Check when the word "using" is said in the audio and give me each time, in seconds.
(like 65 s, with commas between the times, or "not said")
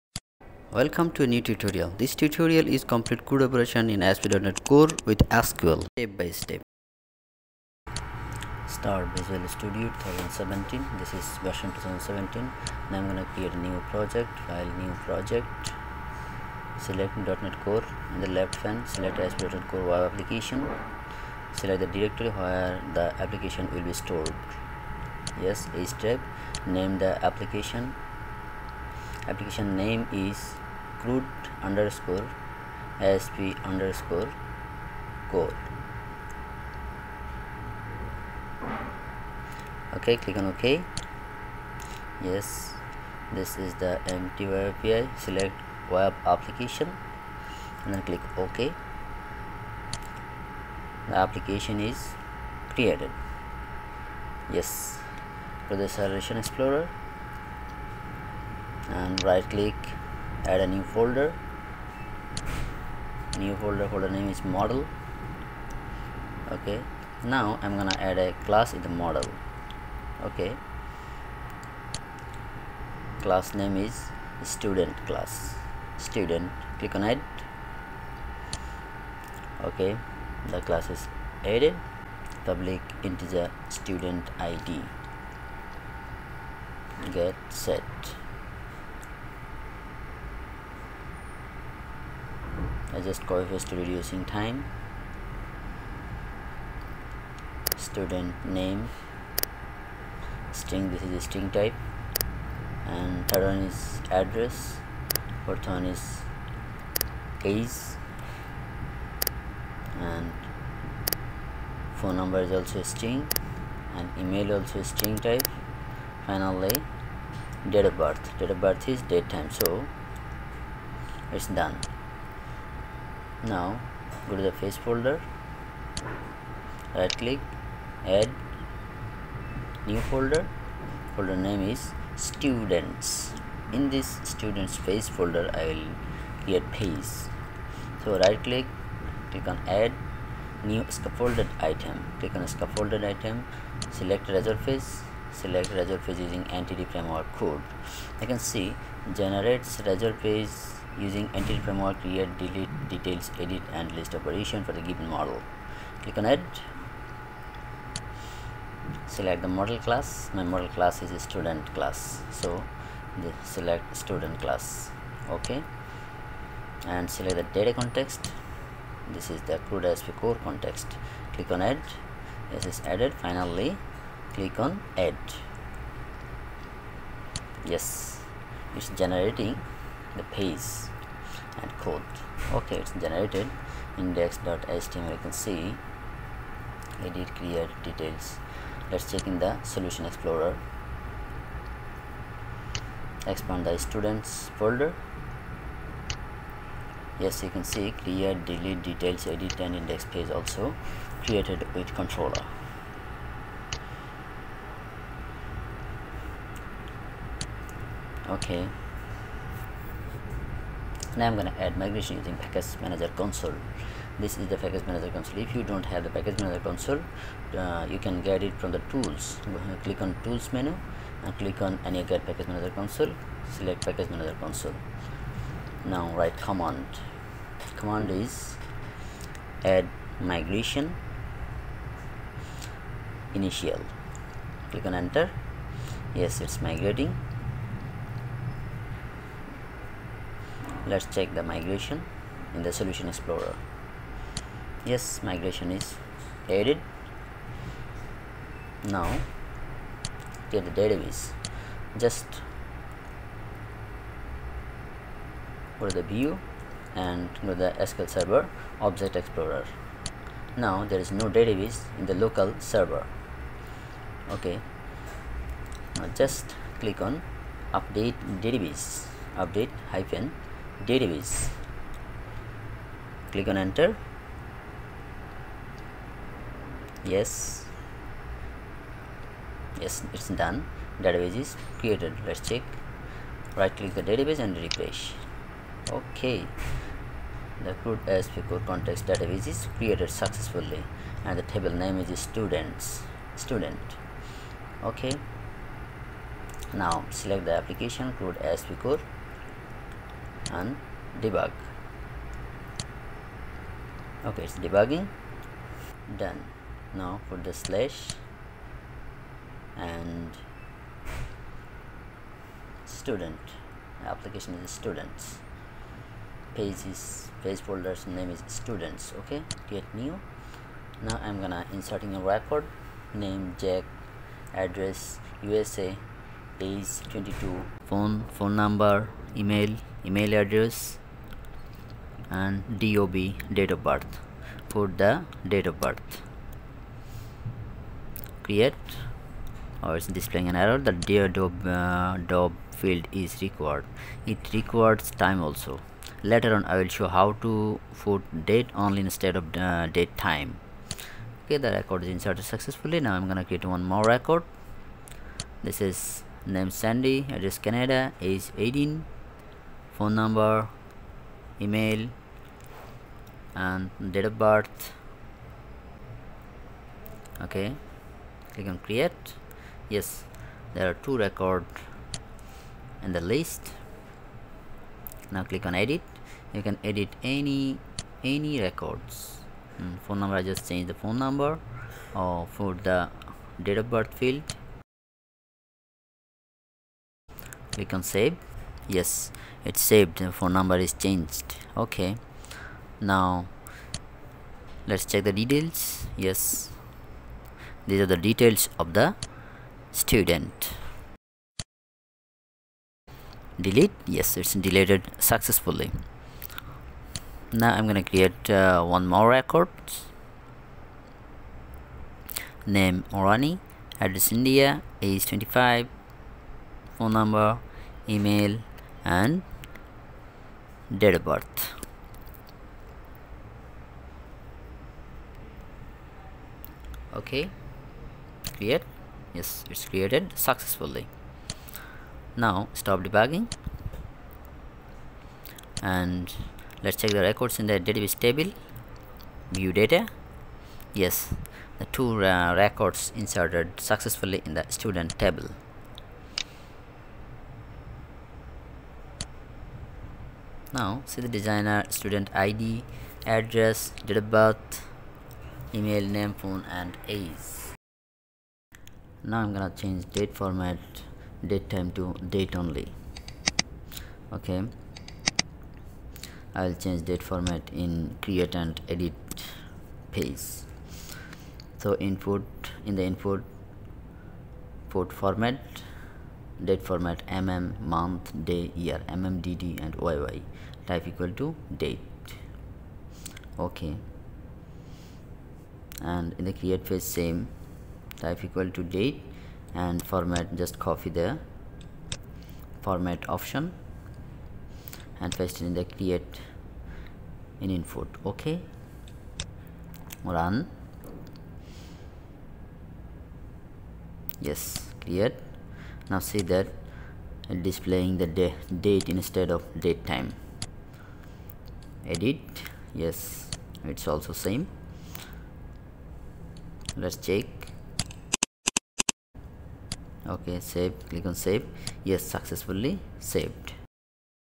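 146 s, 150 s, 212 s.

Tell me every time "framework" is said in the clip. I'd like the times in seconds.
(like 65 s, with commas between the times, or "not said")
146 s, 151 s.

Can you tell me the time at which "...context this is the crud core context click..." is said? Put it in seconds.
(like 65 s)
167 s.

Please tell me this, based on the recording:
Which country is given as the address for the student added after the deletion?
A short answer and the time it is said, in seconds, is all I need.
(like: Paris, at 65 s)
India, at 414 s.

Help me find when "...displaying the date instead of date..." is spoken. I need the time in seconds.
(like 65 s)
507 s.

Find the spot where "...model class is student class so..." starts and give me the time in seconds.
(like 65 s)
160 s.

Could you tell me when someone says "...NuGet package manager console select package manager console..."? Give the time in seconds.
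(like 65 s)
221 s.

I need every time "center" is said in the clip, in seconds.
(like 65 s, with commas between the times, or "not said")
not said.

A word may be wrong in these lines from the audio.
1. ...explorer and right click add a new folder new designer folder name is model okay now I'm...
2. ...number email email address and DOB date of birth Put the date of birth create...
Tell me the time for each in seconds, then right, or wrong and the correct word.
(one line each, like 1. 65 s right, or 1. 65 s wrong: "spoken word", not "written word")
1. 56 s wrong: "folder", not "designer"
2. 328 s right.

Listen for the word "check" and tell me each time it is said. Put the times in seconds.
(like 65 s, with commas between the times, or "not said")
189 s, 241 s, 282 s, 395 s, 436 s, 517 s.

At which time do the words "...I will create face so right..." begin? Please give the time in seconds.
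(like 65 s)
135 s.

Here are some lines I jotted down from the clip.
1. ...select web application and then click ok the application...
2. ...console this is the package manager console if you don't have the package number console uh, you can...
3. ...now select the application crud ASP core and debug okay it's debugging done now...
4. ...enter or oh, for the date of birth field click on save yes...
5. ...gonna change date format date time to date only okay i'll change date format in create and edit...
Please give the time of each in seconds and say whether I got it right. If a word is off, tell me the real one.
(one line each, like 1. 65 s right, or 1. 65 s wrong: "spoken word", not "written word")
1. 45 s right
2. 213 s wrong: "manager", not "number"
3. 296 s right
4. 381 s wrong: "number", not "enter"
5. 459 s right.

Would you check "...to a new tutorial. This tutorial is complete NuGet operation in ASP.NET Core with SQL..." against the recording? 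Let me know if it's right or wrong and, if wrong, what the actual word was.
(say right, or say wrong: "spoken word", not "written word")
wrong: "CRUD", not "NuGet".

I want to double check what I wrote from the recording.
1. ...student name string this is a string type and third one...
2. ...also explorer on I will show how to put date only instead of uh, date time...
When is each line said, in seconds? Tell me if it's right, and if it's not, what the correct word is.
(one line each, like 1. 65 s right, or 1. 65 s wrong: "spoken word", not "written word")
1. 97 s right
2. 345 s wrong: "later", not "explorer".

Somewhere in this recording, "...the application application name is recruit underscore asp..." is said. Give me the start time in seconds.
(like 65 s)
26 s.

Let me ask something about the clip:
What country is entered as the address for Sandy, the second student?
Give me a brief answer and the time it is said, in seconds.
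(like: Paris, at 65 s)
Canada, at 357 s.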